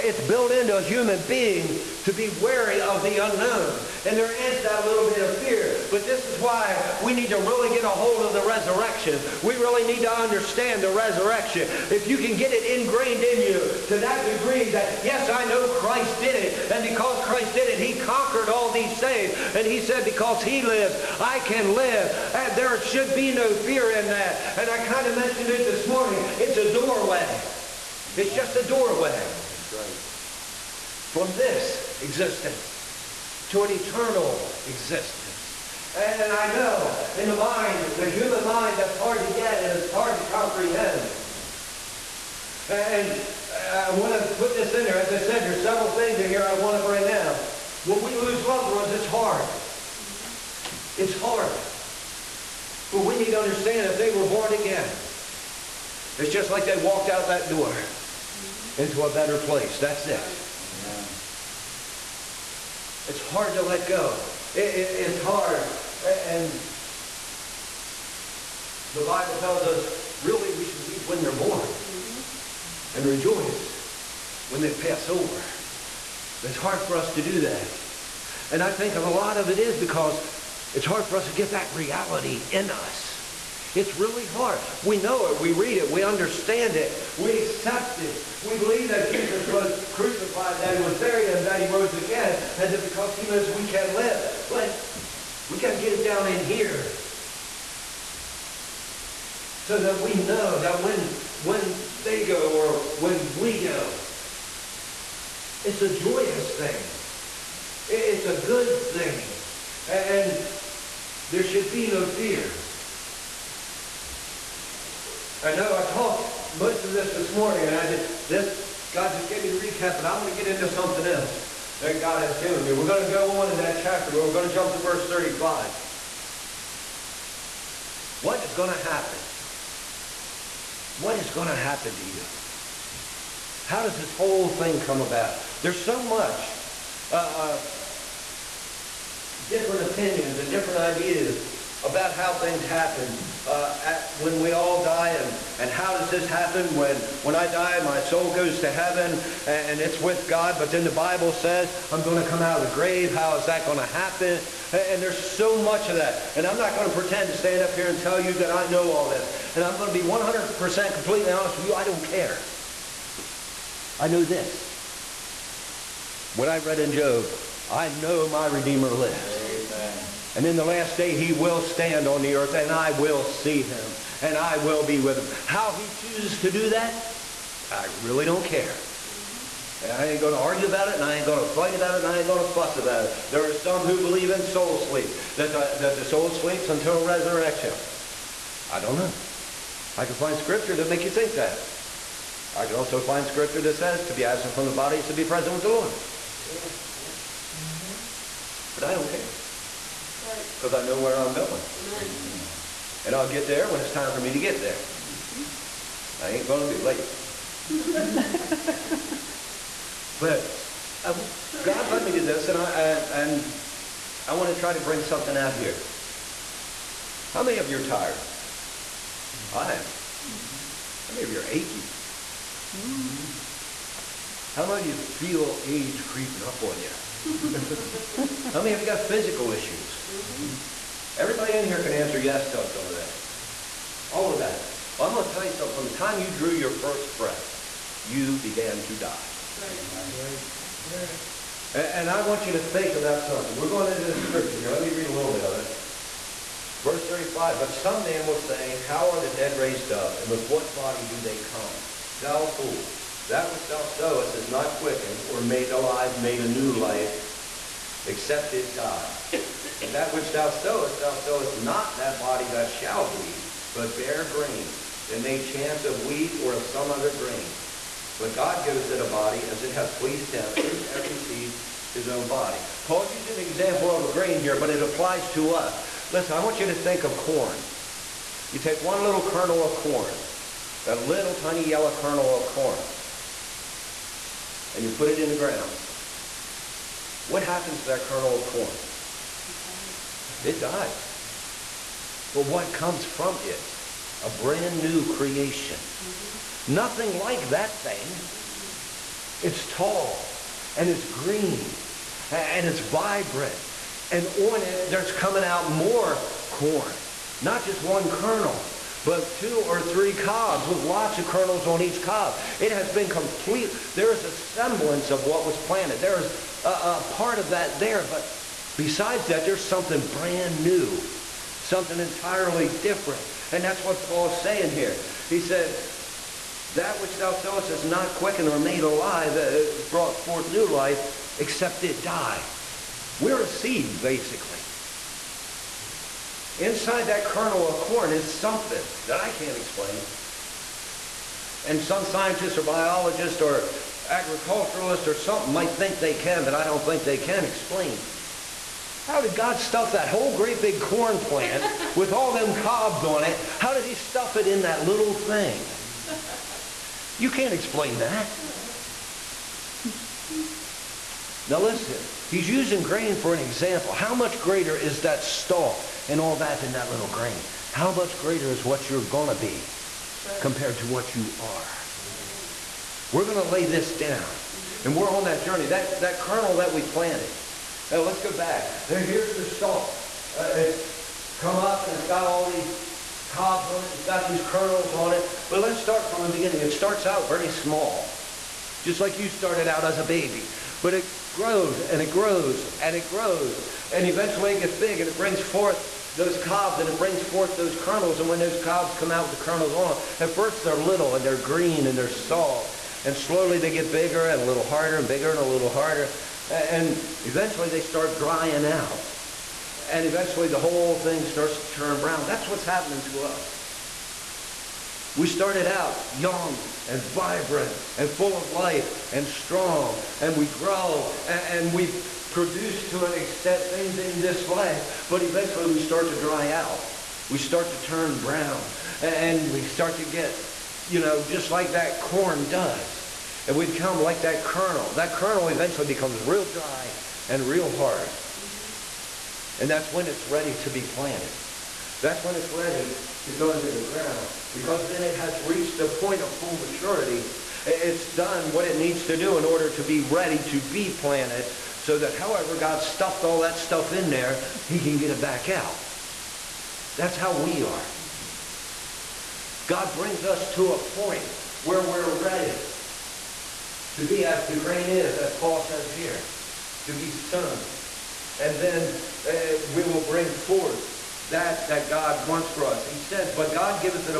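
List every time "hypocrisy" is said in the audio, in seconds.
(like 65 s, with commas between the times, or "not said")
not said.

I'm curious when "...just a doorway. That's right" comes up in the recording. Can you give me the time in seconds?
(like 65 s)
28 s.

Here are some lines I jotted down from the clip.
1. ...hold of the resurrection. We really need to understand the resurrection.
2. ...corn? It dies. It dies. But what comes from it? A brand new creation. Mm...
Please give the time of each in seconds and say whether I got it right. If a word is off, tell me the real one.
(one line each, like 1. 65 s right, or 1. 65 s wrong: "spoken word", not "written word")
1. 7 s right
2. 288 s right.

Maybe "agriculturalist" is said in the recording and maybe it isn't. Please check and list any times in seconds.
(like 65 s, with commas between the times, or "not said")
344 s.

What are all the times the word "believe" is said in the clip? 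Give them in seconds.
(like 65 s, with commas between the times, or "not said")
88 s, 184 s.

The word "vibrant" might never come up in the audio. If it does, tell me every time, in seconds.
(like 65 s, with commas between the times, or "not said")
302 s, 417 s.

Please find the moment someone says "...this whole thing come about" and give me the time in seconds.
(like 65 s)
133 s.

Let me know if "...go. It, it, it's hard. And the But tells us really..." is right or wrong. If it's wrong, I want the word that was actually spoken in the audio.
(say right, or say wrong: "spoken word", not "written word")
wrong: "Bible", not "But".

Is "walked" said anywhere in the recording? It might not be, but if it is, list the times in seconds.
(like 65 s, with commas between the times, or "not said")
56 s.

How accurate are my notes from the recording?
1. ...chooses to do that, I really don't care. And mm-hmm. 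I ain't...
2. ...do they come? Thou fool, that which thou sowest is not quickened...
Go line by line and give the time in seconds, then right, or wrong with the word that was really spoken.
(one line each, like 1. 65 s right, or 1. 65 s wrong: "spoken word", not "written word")
1. 175 s right
2. 251 s right.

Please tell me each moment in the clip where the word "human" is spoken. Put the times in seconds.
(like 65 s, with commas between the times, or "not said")
0 s, 38 s.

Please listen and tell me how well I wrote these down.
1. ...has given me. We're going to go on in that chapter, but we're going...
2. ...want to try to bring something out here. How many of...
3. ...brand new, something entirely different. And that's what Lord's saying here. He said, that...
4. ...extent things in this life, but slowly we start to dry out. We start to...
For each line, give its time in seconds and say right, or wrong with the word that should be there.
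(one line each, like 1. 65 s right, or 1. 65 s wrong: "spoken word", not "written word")
1. 122 s right
2. 214 s right
3. 320 s wrong: "Paul", not "Lord"
4. 423 s wrong: "eventually", not "slowly".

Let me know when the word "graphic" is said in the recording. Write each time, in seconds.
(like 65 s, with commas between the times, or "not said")
not said.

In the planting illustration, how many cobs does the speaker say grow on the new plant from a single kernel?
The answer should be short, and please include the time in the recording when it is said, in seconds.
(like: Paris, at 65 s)
2 or 3, at 309 s.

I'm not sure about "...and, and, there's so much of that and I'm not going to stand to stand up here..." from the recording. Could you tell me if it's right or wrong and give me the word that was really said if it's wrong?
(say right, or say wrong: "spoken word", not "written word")
wrong: "pretend", not "stand".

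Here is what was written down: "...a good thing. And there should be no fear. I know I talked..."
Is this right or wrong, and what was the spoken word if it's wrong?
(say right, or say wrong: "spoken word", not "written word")
right.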